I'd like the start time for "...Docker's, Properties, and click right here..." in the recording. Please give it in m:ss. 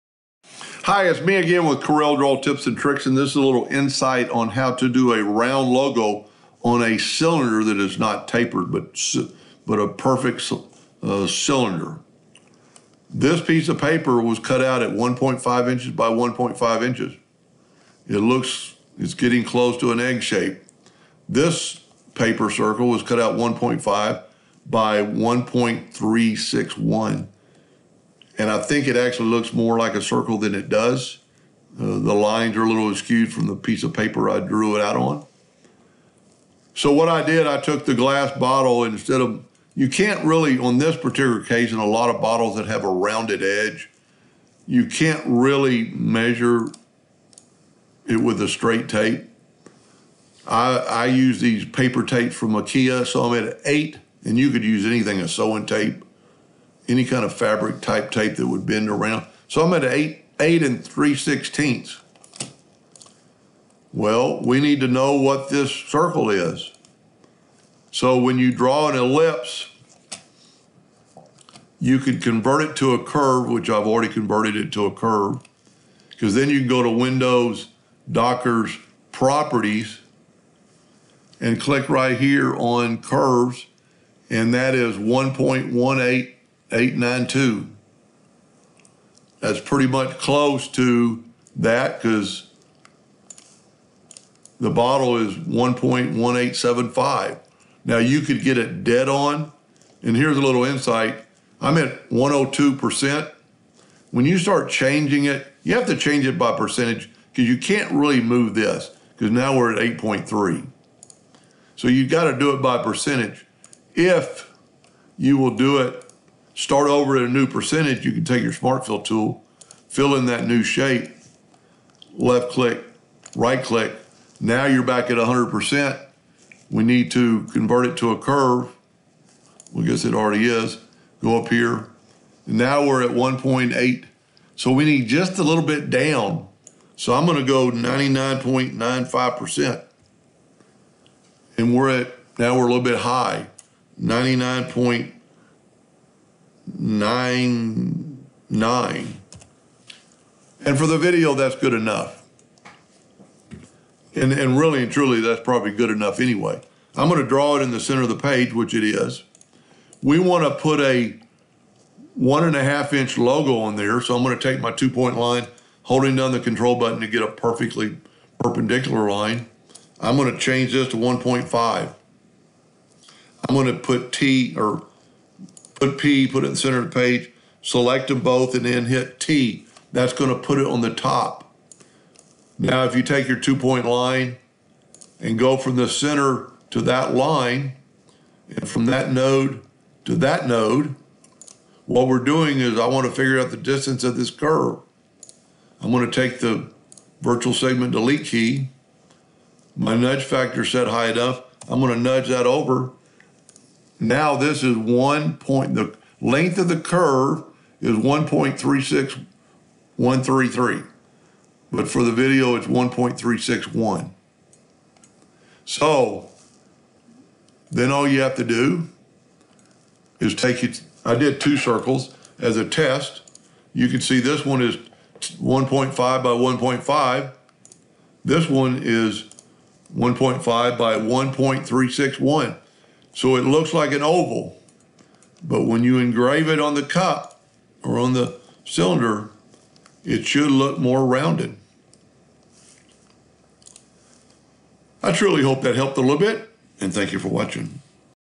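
1:18.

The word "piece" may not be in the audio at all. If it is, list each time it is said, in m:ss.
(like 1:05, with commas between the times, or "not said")
0:13, 0:33.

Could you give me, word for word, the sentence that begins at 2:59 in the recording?
That's going to put it on the top.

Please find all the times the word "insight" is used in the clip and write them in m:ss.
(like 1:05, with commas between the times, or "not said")
0:03, 1:40.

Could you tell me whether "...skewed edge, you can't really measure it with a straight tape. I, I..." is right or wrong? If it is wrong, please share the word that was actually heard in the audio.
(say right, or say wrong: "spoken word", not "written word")
wrong: "rounded", not "skewed".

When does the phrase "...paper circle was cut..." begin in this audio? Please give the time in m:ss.
0:22.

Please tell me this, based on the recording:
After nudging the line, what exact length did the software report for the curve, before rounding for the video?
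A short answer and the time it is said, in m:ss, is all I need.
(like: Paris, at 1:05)
1.36133, at 3:27.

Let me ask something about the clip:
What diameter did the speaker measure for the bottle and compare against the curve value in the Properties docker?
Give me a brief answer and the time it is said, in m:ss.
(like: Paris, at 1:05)
1.1875, at 1:35.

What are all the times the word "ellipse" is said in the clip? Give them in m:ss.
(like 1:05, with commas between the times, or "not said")
1:08.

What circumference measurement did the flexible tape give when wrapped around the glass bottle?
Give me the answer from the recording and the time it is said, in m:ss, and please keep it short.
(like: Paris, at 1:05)
8 3/16, at 1:00.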